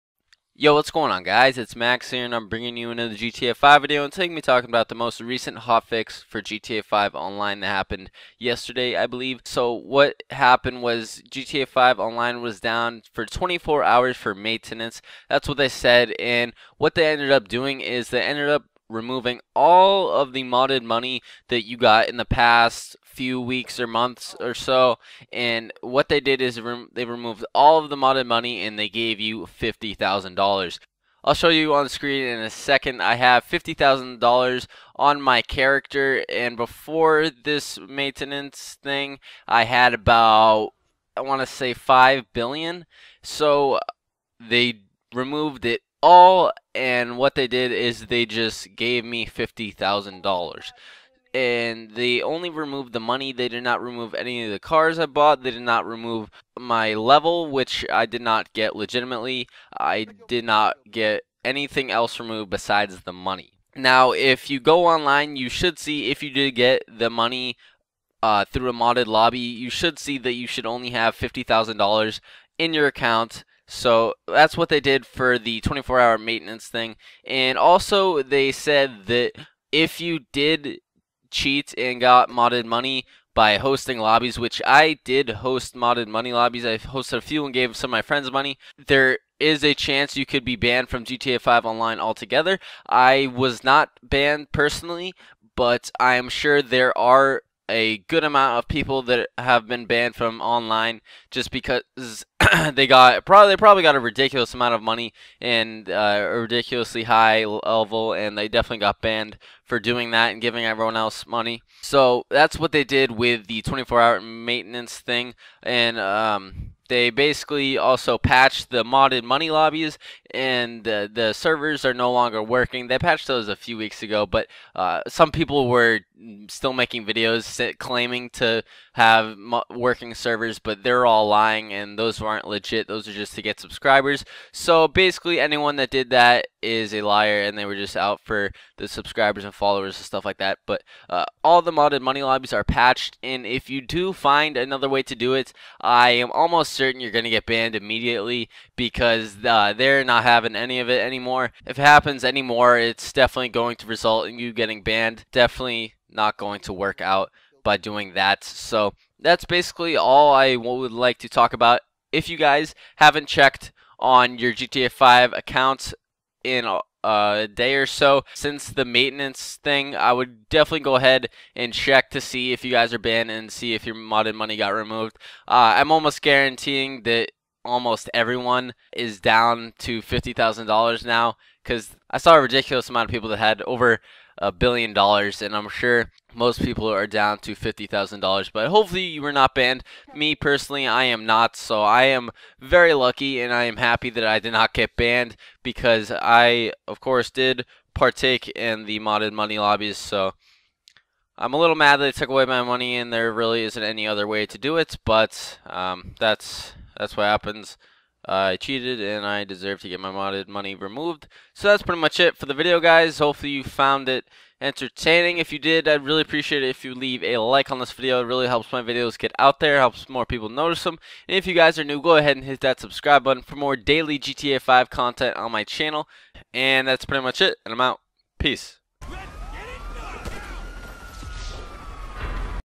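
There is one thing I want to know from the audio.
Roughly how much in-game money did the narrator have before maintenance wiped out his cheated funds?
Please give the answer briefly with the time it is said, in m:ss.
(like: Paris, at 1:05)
5 billion, at 0:41.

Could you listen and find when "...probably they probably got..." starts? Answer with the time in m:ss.
1:43.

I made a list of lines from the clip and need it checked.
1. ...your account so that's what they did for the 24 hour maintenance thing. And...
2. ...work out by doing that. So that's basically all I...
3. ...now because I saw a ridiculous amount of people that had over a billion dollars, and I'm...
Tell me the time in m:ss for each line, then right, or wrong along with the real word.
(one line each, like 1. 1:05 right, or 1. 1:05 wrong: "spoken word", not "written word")
1. 1:12 right
2. 2:36 right
3. 3:01 right.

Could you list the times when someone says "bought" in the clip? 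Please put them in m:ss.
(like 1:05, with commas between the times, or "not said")
0:55.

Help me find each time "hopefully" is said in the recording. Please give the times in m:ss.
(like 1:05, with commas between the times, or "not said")
3:08, 3:33.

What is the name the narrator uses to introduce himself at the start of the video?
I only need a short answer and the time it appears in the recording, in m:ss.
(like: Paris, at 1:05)
Max, at 0:01.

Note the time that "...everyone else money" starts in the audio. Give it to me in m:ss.
1:50.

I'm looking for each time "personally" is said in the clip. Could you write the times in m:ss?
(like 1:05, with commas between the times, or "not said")
1:34, 3:10.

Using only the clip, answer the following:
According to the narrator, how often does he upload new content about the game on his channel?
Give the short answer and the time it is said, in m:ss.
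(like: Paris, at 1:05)
daily, at 3:43.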